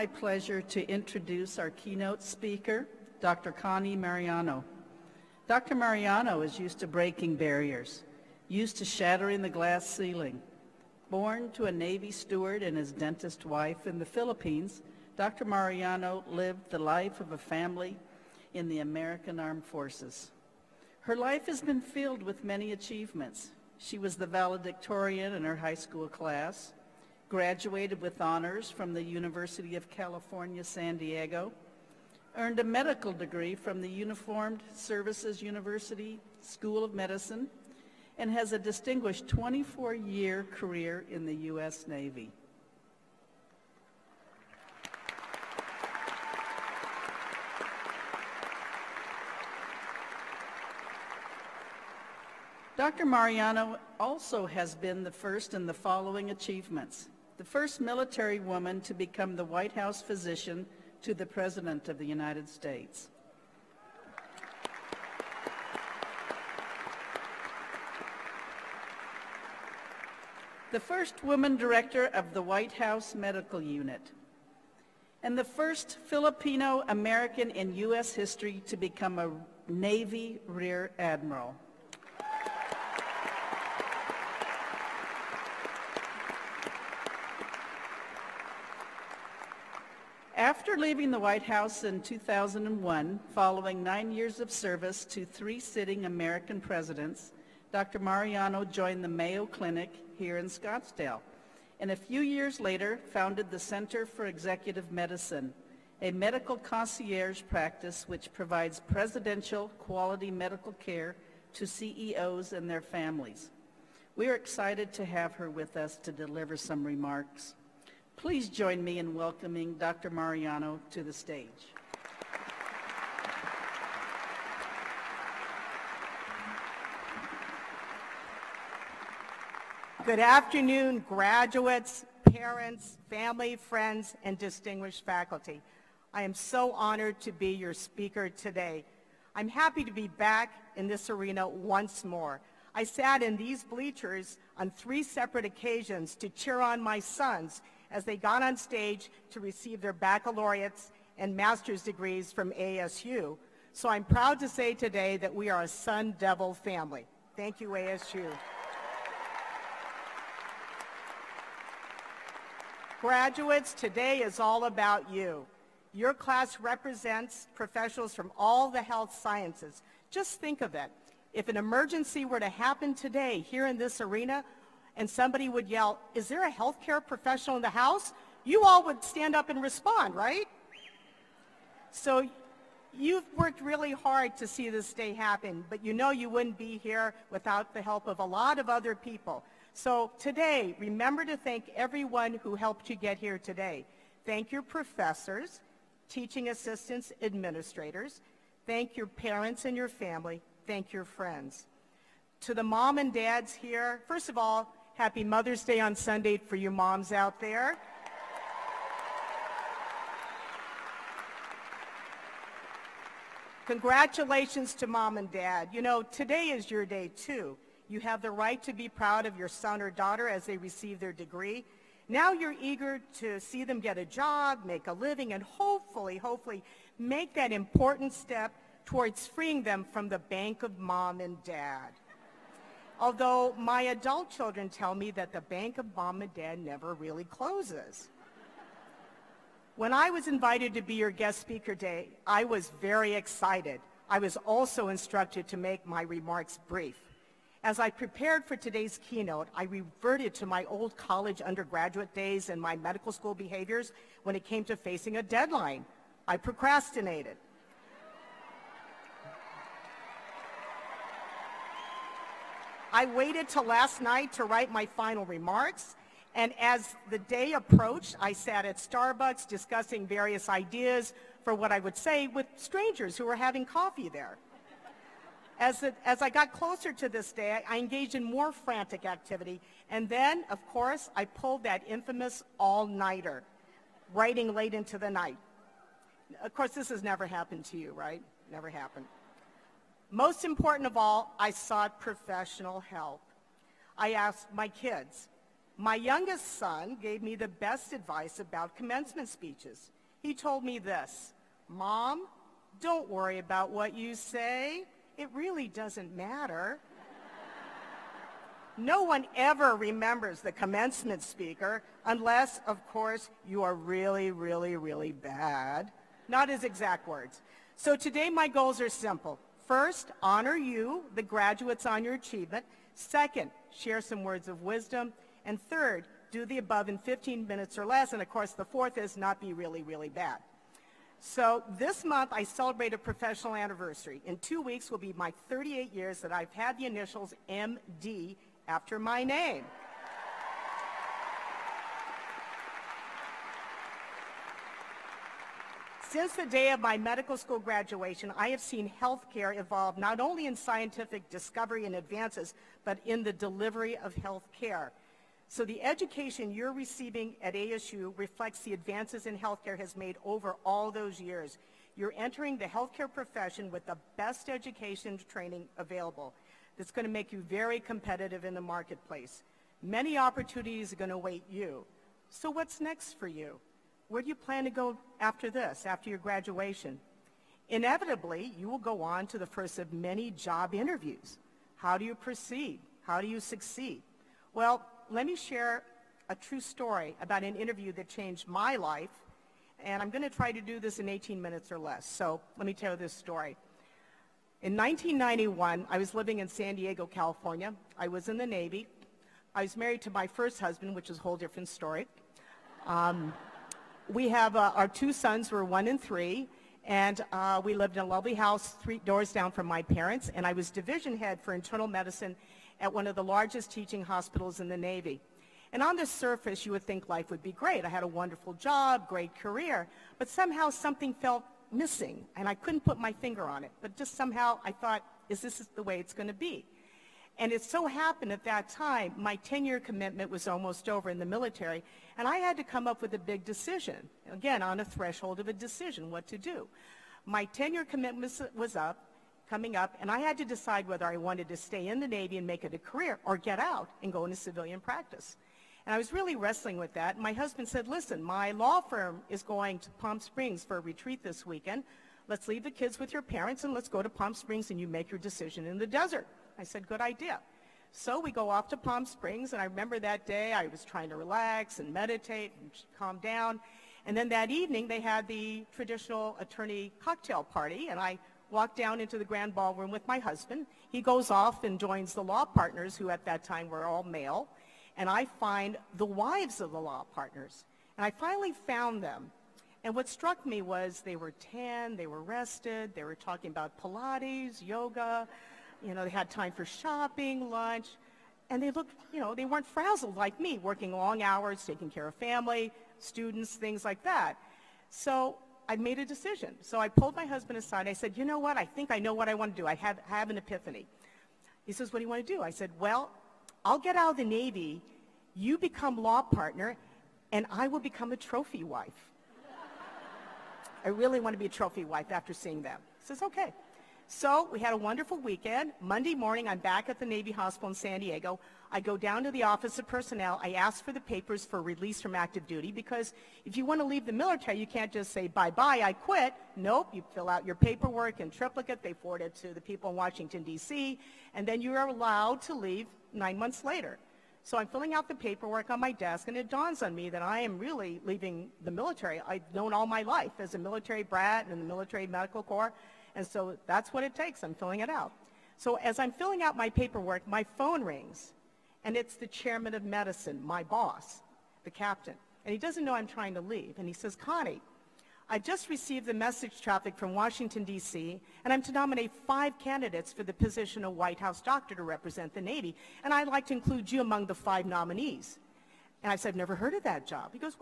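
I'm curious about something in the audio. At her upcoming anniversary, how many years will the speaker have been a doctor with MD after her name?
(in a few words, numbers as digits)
38.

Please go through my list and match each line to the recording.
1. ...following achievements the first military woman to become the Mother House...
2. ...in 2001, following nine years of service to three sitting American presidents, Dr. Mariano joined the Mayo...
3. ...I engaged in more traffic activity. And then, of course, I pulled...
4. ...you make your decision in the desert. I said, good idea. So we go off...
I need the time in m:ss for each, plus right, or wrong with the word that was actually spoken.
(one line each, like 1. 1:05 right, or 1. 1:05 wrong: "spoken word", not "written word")
1. 0:55 wrong: "White", not "Mother"
2. 1:31 right
3. 4:37 wrong: "frantic", not "traffic"
4. 7:34 right.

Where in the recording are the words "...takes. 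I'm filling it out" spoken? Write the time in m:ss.
9:04.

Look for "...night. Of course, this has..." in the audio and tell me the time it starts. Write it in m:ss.
4:45.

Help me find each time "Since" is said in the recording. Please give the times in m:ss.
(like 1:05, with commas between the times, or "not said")
5:46.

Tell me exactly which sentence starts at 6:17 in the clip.
Inevitably, you will go on to the first of many job interviews.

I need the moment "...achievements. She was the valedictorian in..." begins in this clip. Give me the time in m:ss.
0:22.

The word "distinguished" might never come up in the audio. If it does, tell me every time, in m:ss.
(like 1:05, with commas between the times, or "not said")
0:38, 2:14.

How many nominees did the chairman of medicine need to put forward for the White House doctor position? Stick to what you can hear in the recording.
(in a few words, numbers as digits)
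5.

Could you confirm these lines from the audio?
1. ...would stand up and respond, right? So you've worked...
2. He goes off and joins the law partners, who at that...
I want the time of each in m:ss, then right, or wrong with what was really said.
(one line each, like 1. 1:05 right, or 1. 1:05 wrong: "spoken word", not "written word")
1. 2:58 right
2. 7:50 right.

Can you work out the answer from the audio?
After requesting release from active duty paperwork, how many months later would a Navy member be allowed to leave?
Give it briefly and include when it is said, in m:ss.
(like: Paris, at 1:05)
9 months, at 8:53.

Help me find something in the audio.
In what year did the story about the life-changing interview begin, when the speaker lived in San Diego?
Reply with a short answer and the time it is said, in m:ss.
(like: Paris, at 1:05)
1991, at 6:34.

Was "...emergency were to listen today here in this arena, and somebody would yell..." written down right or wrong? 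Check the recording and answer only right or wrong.
wrong.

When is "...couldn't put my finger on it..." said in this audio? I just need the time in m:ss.
7:02.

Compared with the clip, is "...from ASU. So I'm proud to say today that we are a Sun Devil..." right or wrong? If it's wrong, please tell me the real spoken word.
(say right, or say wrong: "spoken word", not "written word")
right.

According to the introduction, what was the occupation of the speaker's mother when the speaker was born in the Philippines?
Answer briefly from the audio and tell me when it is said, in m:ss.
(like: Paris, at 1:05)
Dentist, at 0:12.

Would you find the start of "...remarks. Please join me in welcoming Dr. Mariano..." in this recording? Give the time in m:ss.
1:56.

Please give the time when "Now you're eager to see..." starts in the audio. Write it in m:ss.
3:42.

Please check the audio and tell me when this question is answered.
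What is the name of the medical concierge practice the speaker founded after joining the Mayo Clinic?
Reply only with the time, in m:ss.
1:43.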